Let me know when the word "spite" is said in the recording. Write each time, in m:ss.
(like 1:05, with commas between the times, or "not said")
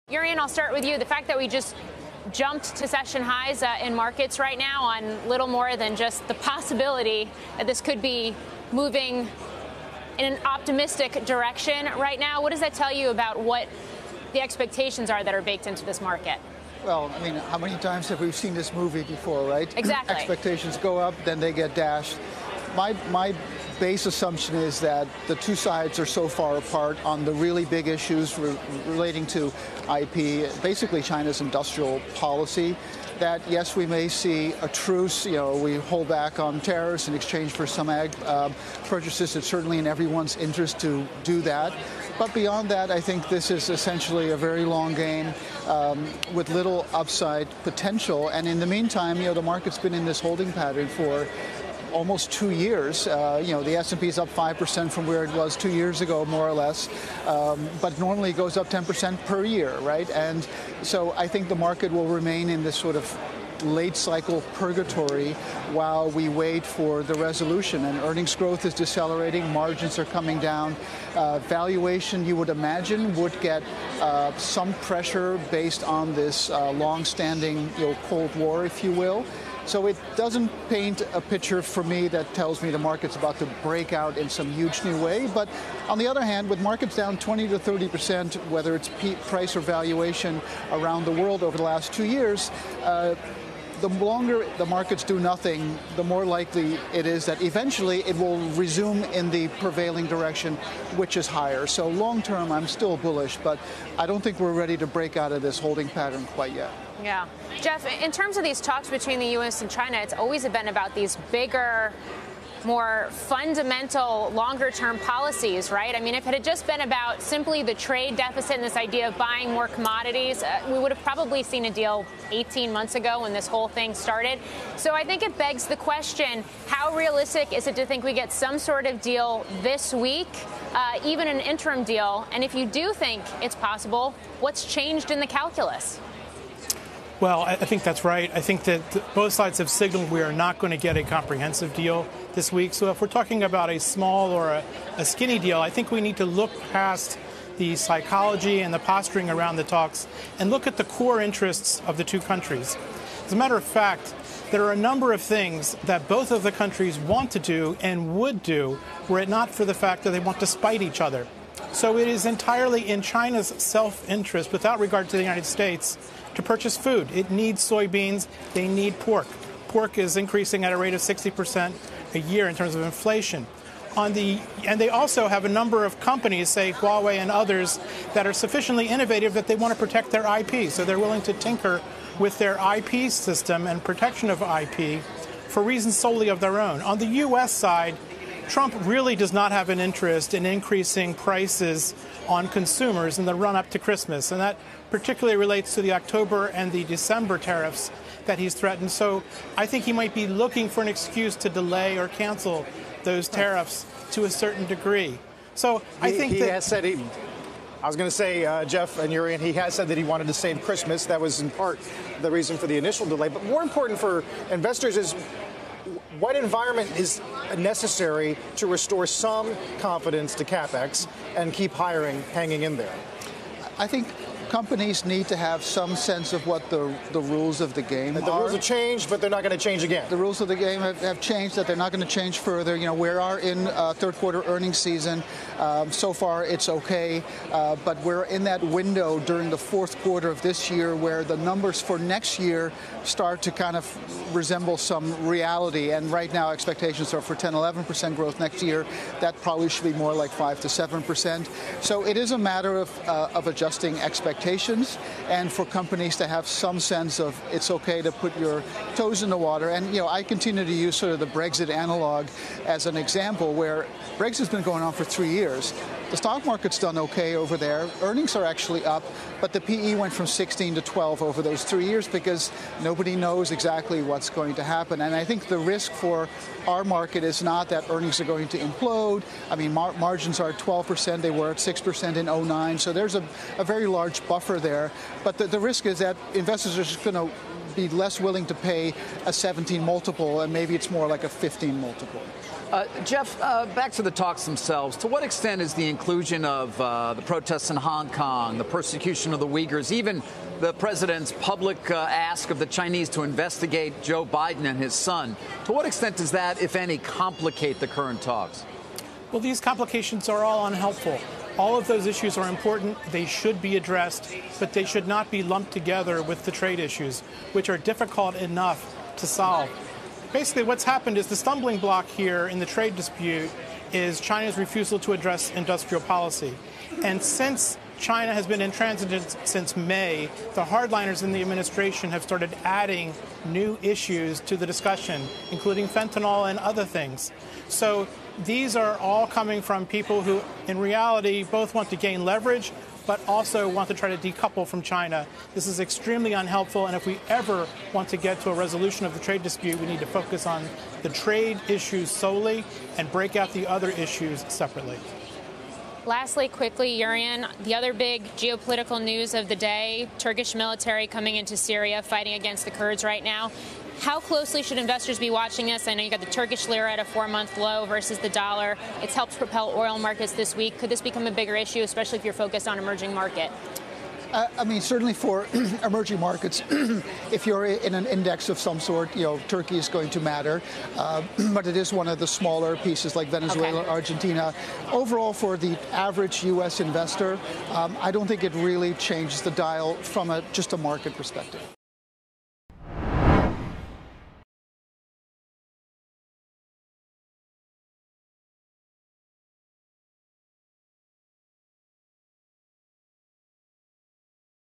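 2:40.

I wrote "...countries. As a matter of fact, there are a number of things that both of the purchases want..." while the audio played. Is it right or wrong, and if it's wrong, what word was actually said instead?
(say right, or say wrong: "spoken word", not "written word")
wrong: "countries", not "purchases".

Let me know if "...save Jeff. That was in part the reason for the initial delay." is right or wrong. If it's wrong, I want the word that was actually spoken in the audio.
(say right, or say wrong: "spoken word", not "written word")
wrong: "Christmas", not "Jeff".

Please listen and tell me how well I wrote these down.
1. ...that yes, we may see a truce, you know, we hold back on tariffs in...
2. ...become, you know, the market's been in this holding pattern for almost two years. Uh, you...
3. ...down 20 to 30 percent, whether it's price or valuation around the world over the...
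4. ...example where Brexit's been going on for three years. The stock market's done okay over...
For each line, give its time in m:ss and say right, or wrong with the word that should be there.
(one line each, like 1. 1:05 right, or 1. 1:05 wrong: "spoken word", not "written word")
1. 0:33 right
2. 0:48 wrong: "meantime", not "become"
3. 1:26 right
4. 4:22 right.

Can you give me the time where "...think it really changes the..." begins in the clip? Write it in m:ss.
6:28.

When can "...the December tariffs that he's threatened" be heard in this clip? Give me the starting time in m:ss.
3:16.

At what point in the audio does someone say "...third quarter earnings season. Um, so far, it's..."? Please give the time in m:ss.
3:53.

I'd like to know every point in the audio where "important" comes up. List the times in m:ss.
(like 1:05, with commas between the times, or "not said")
3:33, 5:12.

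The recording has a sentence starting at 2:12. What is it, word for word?
And if you do think it's possible, what's changed in the calculus?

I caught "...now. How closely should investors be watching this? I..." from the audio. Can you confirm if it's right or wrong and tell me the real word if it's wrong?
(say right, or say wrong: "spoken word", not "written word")
right.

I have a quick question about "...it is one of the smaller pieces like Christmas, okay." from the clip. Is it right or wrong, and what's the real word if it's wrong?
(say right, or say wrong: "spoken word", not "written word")
wrong: "Venezuela", not "Christmas".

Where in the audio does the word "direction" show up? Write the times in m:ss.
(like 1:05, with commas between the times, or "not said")
0:11, 1:40.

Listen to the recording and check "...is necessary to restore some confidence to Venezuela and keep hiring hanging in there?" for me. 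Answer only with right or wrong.
wrong.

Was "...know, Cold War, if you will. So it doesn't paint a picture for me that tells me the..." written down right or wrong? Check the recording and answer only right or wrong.
right.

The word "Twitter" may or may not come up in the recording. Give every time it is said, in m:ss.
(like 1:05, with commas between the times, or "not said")
not said.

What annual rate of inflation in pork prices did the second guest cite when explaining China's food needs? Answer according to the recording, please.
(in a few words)
60%.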